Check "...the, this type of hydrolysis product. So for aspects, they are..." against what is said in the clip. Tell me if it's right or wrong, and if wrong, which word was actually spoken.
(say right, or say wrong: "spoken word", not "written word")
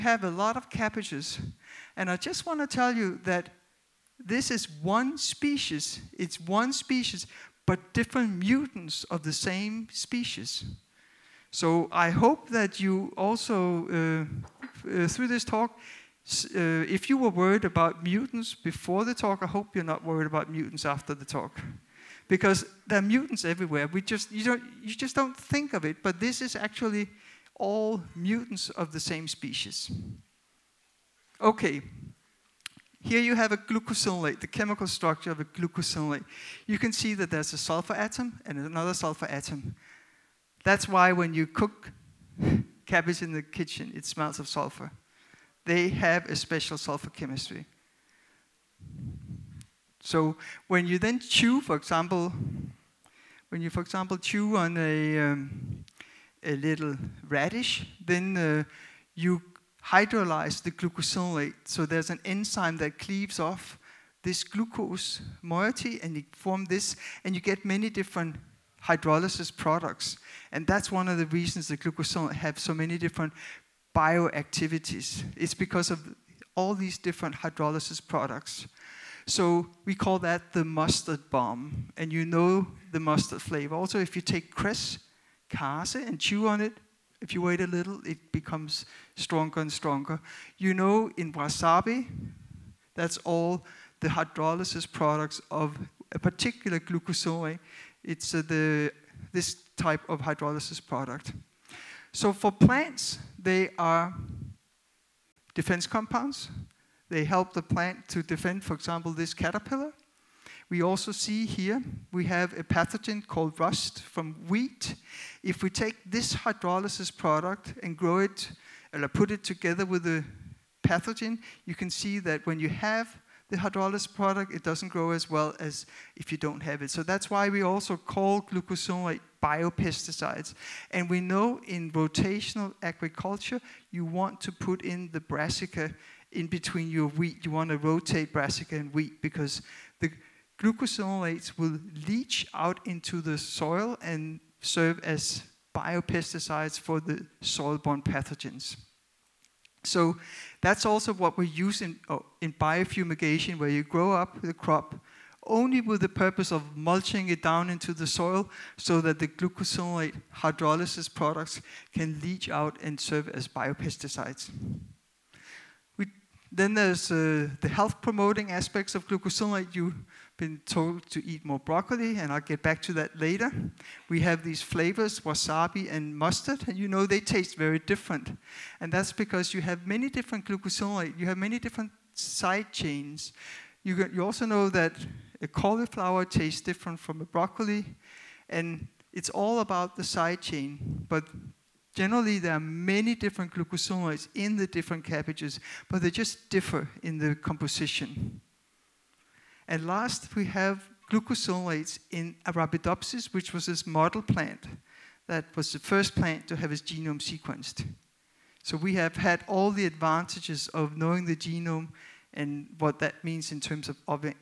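wrong: "plants", not "aspects".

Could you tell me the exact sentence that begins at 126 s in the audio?
So that's why we also call glucosinolate biopesticides.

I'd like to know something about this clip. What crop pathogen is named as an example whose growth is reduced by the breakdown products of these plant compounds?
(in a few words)
Rust.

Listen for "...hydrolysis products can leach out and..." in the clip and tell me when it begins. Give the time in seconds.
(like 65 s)
160 s.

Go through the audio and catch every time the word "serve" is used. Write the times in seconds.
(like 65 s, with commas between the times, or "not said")
144 s, 162 s.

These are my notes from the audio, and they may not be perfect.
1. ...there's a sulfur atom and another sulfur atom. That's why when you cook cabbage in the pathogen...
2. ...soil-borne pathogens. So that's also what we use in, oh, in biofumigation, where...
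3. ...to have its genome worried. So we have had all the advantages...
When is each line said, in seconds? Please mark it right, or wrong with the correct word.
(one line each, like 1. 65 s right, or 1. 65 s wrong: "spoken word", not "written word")
1. 37 s wrong: "kitchen", not "pathogen"
2. 147 s right
3. 206 s wrong: "sequenced", not "worried".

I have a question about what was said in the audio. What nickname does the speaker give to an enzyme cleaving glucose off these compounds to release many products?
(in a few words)
The mustard bomb.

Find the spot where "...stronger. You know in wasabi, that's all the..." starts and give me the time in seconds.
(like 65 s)
89 s.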